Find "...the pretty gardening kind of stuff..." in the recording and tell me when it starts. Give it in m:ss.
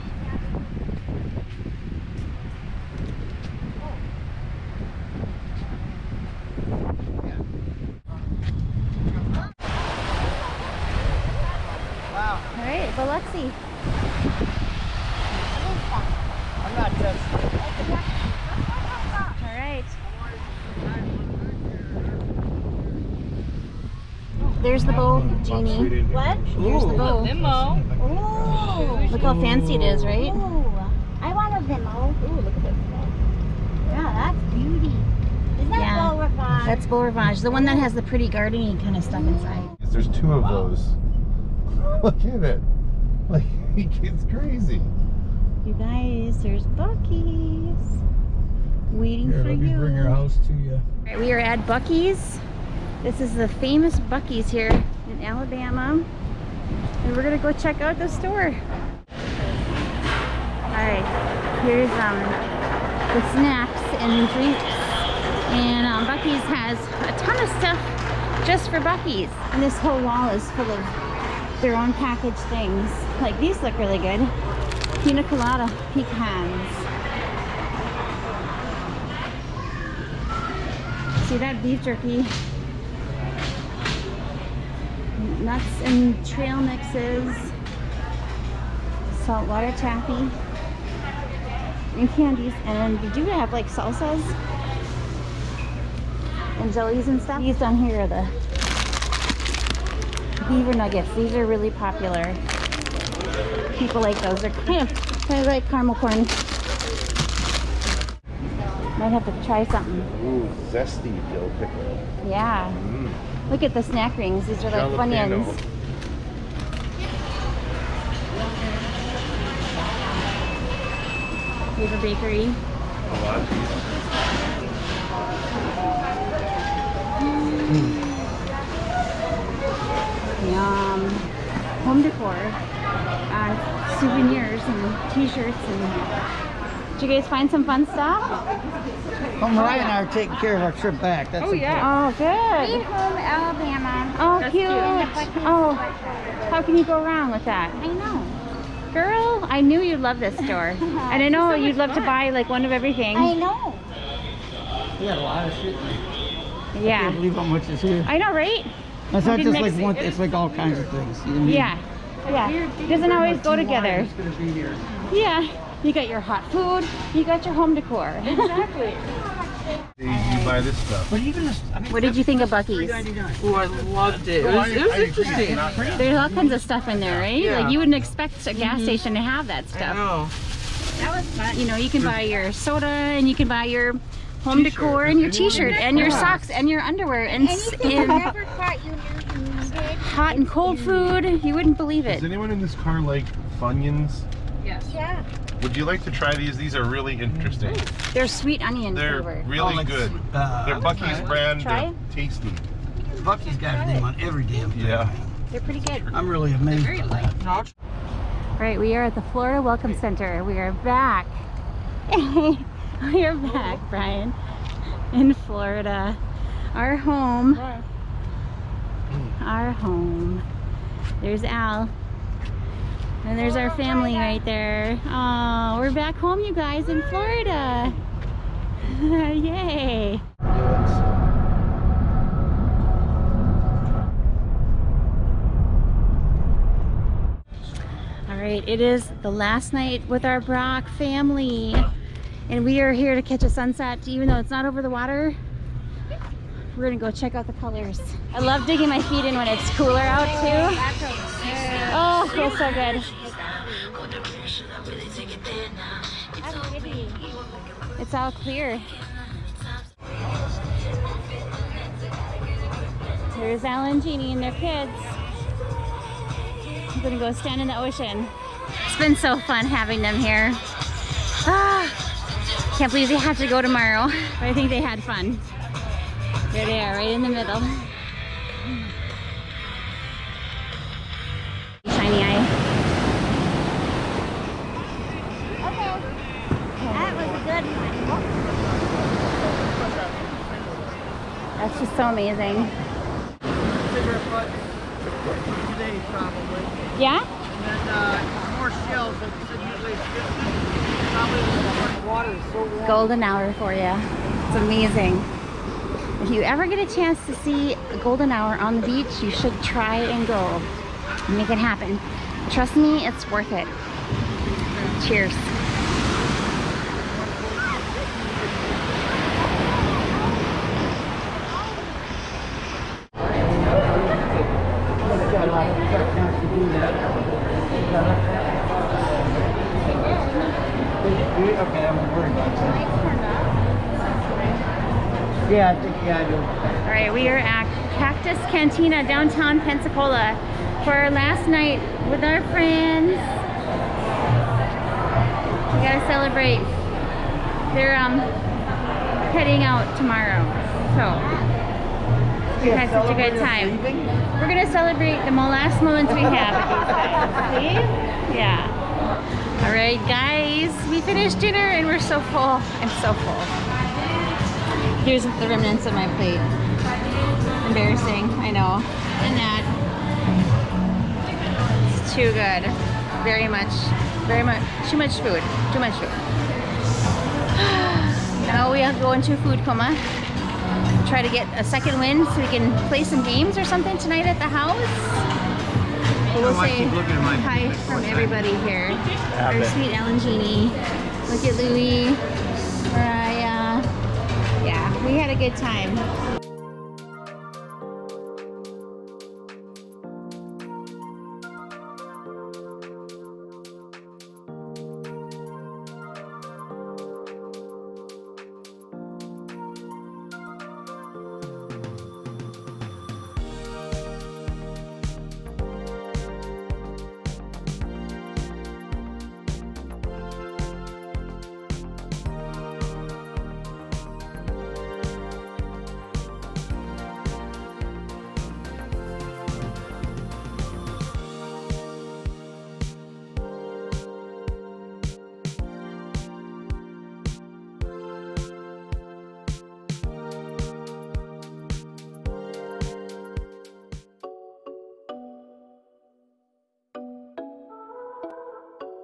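0:37.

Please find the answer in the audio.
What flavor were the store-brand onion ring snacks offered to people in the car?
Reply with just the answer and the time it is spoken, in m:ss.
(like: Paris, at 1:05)
Sweet onion, at 3:18.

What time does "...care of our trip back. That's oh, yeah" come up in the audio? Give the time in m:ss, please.
2:20.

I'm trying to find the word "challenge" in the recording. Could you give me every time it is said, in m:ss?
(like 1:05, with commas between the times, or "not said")
not said.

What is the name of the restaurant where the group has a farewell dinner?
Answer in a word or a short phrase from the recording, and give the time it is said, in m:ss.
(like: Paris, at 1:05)
Cactus Cantina, at 5:37.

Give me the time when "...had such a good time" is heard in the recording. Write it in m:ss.
5:52.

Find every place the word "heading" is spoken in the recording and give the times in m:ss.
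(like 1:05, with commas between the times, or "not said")
5:49.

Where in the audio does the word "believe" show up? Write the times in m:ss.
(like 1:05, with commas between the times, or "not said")
2:37, 3:11, 4:32.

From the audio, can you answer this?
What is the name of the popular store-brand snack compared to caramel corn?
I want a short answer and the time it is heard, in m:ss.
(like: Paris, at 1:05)
Beaver nuggets, at 1:40.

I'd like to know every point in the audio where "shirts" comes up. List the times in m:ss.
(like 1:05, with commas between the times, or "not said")
2:15, 3:05.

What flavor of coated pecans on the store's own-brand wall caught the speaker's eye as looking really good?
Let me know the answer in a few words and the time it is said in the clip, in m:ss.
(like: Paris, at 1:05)
Pina colada, at 1:15.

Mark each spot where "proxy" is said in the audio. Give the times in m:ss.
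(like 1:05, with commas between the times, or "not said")
not said.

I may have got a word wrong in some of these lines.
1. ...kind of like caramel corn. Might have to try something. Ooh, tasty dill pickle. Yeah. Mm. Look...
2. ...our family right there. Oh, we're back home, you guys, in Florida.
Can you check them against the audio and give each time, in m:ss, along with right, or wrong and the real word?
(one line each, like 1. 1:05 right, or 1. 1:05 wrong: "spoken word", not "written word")
1. 1:45 wrong: "zesty", not "tasty"
2. 3:43 right.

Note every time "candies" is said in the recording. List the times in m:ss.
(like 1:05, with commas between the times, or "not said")
1:32.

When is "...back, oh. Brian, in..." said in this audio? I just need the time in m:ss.
3:33.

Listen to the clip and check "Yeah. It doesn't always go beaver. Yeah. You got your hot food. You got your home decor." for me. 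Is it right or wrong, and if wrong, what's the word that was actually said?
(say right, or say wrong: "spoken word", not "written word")
wrong: "together", not "beaver".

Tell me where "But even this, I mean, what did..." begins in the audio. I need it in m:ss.
2:51.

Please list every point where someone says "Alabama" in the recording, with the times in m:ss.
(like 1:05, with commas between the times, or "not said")
0:55, 2:23.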